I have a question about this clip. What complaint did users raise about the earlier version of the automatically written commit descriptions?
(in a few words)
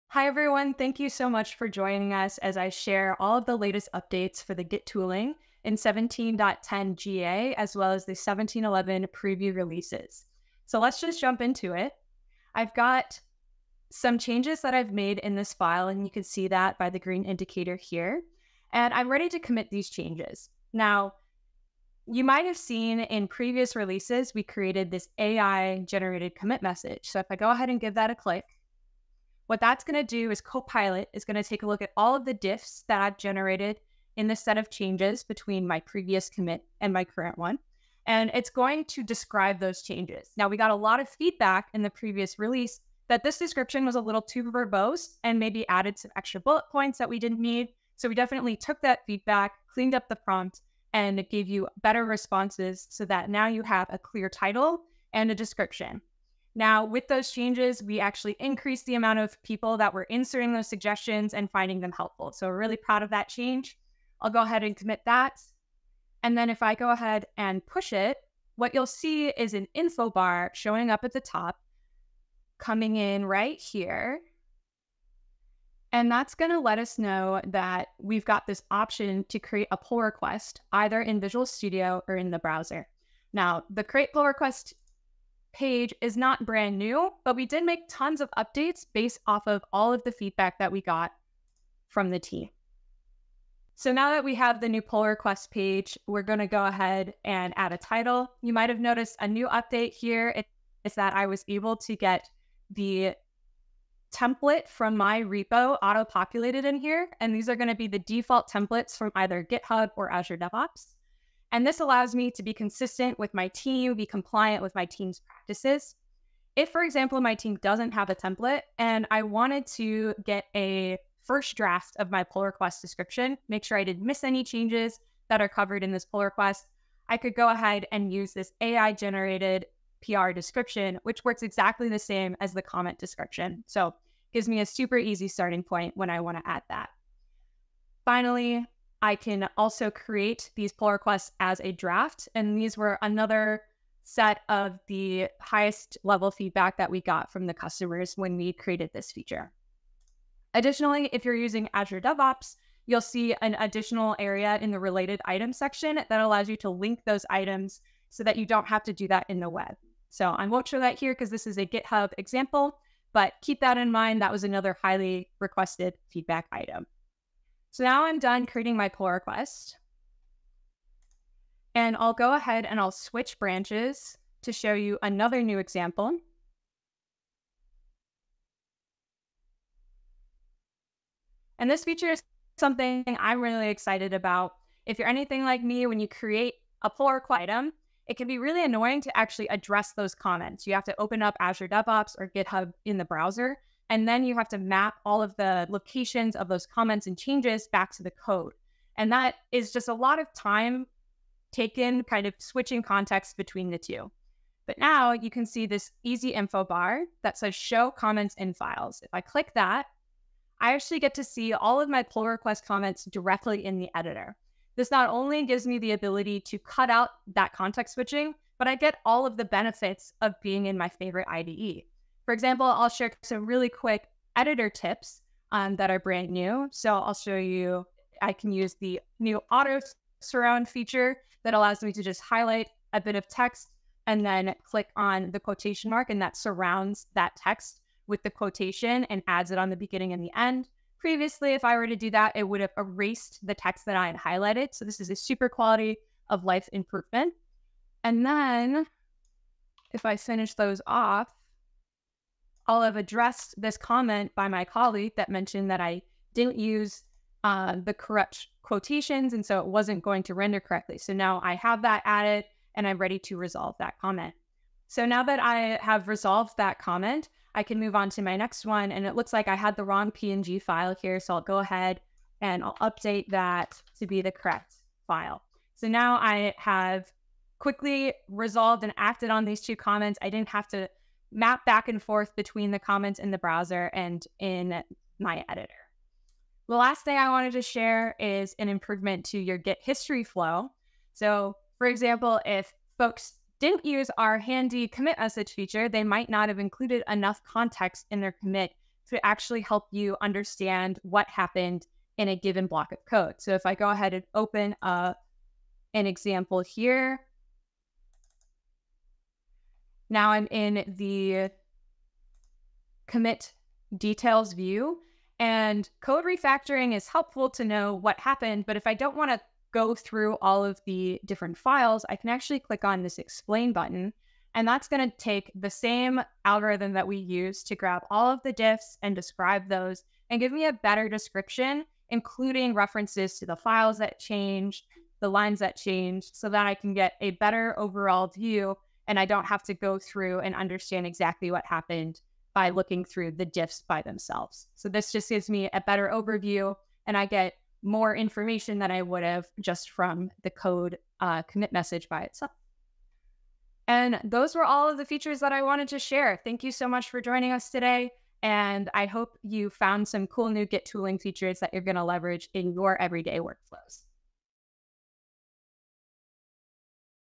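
Too verbose.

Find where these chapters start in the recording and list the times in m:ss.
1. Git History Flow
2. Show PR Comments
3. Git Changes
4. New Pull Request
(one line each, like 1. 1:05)
1. 4:46
2. 3:01
3. 0:13
4. 1:24.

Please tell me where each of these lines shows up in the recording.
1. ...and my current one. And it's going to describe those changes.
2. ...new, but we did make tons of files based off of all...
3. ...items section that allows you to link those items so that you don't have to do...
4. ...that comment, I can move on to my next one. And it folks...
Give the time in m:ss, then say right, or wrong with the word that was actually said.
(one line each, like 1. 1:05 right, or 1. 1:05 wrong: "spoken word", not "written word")
1. 0:36 right
2. 1:26 wrong: "updates", not "files"
3. 2:35 right
4. 4:26 wrong: "looks", not "folks".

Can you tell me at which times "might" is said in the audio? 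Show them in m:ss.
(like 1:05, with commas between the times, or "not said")
0:22, 1:38, 4:56.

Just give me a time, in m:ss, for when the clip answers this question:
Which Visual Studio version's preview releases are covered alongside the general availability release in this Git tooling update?
0:08.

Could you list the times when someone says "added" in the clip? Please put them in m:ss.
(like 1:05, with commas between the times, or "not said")
0:45, 4:22.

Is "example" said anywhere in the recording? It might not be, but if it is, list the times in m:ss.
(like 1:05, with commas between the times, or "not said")
1:56, 2:42, 2:55, 3:42, 4:51, 5:06.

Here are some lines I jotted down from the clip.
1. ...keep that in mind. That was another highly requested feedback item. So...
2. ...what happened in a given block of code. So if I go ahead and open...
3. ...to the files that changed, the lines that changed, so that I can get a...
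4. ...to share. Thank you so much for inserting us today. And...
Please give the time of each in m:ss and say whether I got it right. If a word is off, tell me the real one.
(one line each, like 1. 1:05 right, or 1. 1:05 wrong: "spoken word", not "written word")
1. 2:43 right
2. 5:01 right
3. 5:33 right
4. 5:55 wrong: "joining", not "inserting".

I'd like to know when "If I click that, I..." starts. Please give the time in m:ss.
3:29.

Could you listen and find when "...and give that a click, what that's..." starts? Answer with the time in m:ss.
0:27.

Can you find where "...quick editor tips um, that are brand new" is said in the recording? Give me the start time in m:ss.
3:43.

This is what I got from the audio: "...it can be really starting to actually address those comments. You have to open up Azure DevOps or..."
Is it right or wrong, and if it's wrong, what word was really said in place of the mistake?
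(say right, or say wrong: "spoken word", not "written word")
wrong: "annoying", not "starting".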